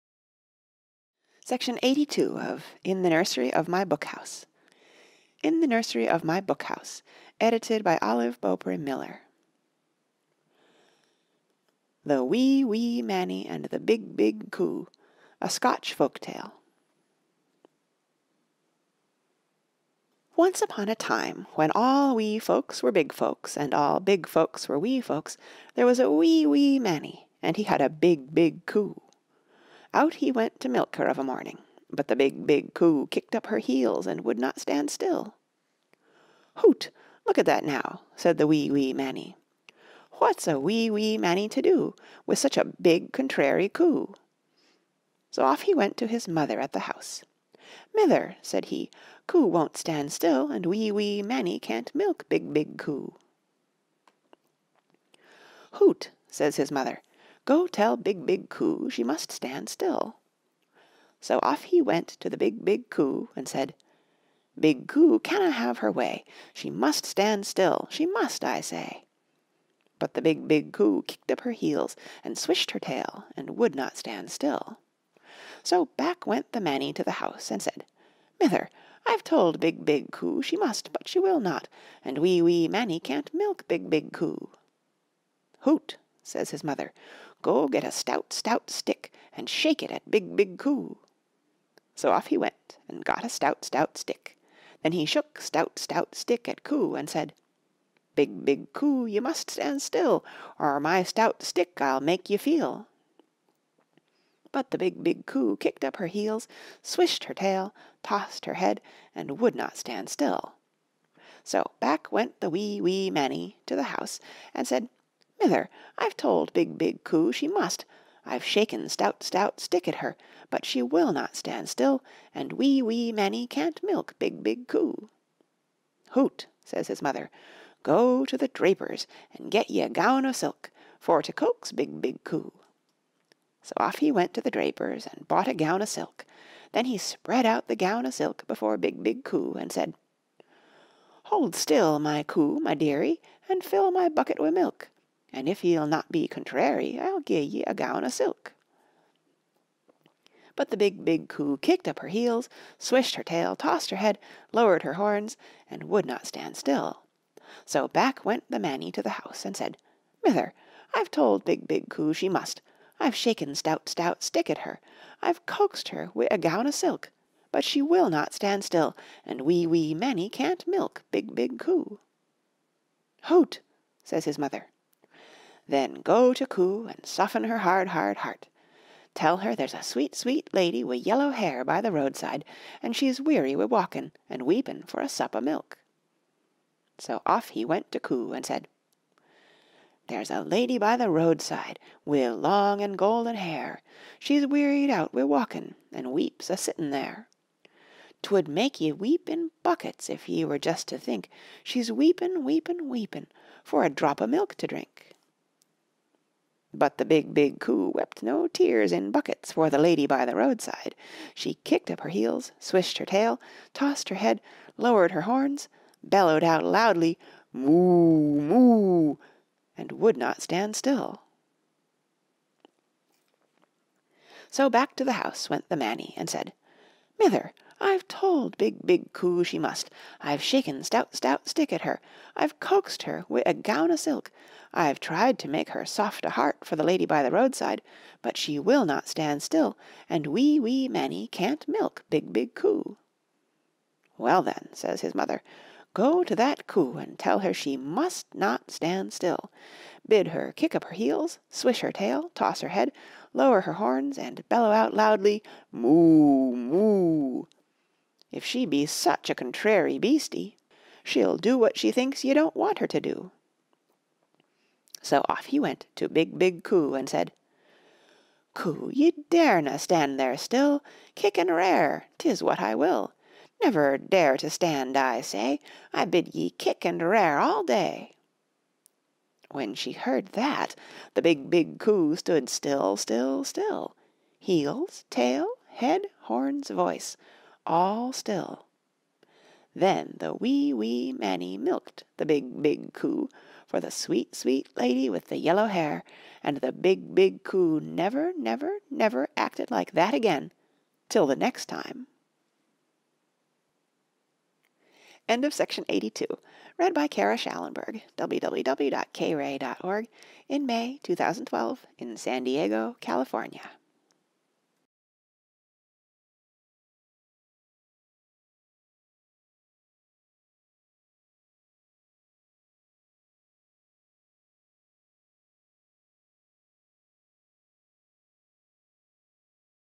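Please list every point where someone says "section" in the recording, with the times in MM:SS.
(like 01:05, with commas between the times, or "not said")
00:01, 05:05.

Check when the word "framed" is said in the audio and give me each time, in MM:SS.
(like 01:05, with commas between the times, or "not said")
not said.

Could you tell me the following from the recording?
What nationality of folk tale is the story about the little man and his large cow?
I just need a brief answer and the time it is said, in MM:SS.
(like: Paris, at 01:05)
Scotch, at 00:15.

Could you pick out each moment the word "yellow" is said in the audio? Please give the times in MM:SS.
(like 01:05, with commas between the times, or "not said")
03:00, 04:55.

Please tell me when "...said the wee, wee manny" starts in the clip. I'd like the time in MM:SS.
00:38.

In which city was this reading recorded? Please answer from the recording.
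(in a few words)
San Diego.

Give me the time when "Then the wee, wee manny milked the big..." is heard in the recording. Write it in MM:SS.
04:49.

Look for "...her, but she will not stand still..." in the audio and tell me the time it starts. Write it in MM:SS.
01:59.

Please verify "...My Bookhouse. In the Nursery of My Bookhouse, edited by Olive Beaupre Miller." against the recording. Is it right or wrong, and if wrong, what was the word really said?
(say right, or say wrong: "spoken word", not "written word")
right.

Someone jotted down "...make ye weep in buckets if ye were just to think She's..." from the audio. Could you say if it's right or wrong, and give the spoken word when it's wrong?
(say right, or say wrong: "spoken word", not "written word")
right.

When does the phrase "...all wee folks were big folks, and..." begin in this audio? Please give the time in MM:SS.
00:21.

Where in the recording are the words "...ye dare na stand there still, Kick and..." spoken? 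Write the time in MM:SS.
04:28.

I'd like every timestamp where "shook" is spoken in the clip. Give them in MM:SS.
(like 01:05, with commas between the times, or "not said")
01:35.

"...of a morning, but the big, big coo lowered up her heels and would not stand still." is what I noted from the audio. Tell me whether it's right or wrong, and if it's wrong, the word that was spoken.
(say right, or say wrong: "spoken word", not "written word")
wrong: "kicked", not "lowered".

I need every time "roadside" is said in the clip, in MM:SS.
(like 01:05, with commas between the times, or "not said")
03:01, 03:11, 03:30, 03:57.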